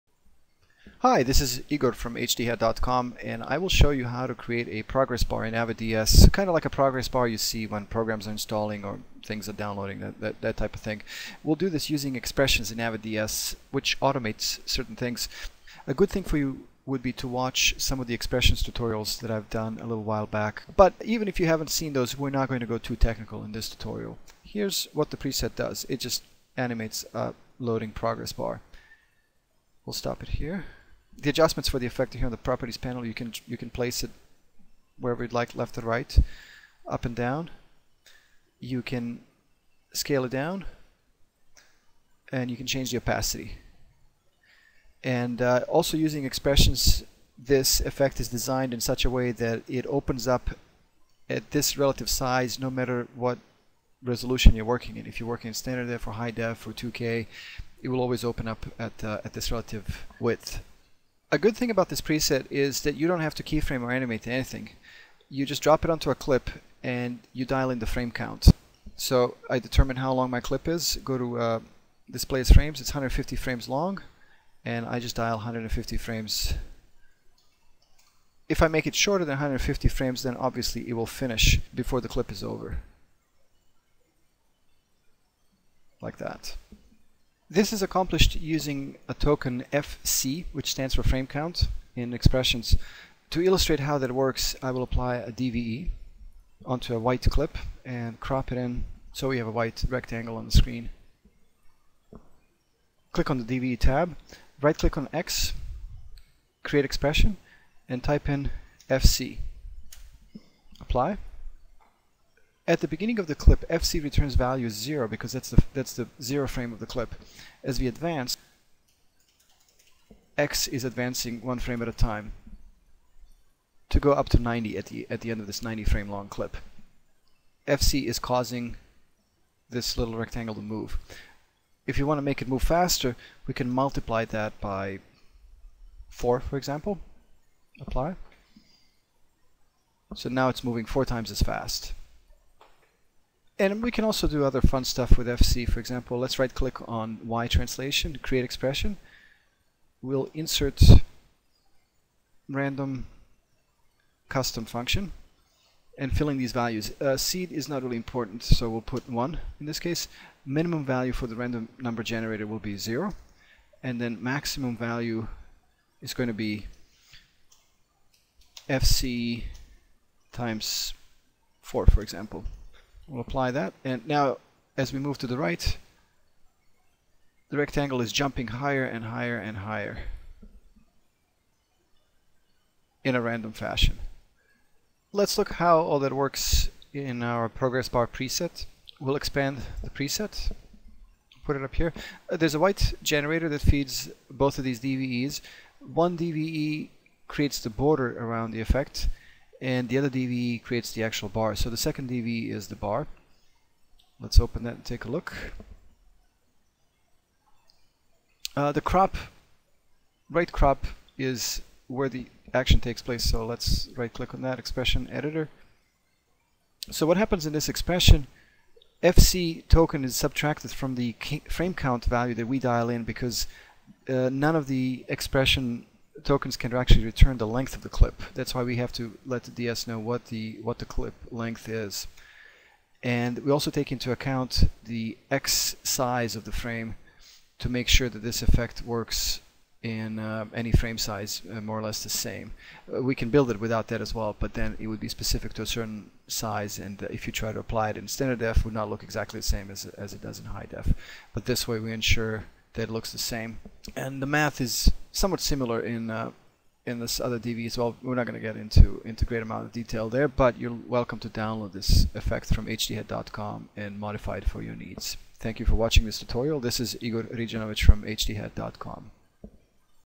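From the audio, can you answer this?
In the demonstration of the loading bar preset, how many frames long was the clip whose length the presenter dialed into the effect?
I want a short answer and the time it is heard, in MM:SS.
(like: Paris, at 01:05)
150, at 01:12.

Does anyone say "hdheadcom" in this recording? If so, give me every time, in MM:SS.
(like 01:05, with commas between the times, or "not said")
00:02, 04:22, 04:28.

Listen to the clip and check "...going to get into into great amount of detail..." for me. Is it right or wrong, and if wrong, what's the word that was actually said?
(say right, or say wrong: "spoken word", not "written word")
right.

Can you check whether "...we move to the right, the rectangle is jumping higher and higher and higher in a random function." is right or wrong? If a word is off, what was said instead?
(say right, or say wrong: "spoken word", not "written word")
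wrong: "fashion", not "function".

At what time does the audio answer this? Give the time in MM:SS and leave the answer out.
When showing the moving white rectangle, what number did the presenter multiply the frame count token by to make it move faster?
02:13.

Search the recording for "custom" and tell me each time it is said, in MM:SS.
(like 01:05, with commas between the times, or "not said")
02:34.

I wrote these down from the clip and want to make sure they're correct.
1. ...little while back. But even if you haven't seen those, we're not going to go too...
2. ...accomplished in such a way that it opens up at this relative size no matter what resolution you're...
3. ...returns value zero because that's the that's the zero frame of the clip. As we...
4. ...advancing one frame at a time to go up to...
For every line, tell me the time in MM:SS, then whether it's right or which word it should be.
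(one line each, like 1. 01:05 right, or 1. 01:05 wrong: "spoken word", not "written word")
1. 00:19 right
2. 00:48 wrong: "designed", not "accomplished"
3. 01:54 right
4. 02:00 right.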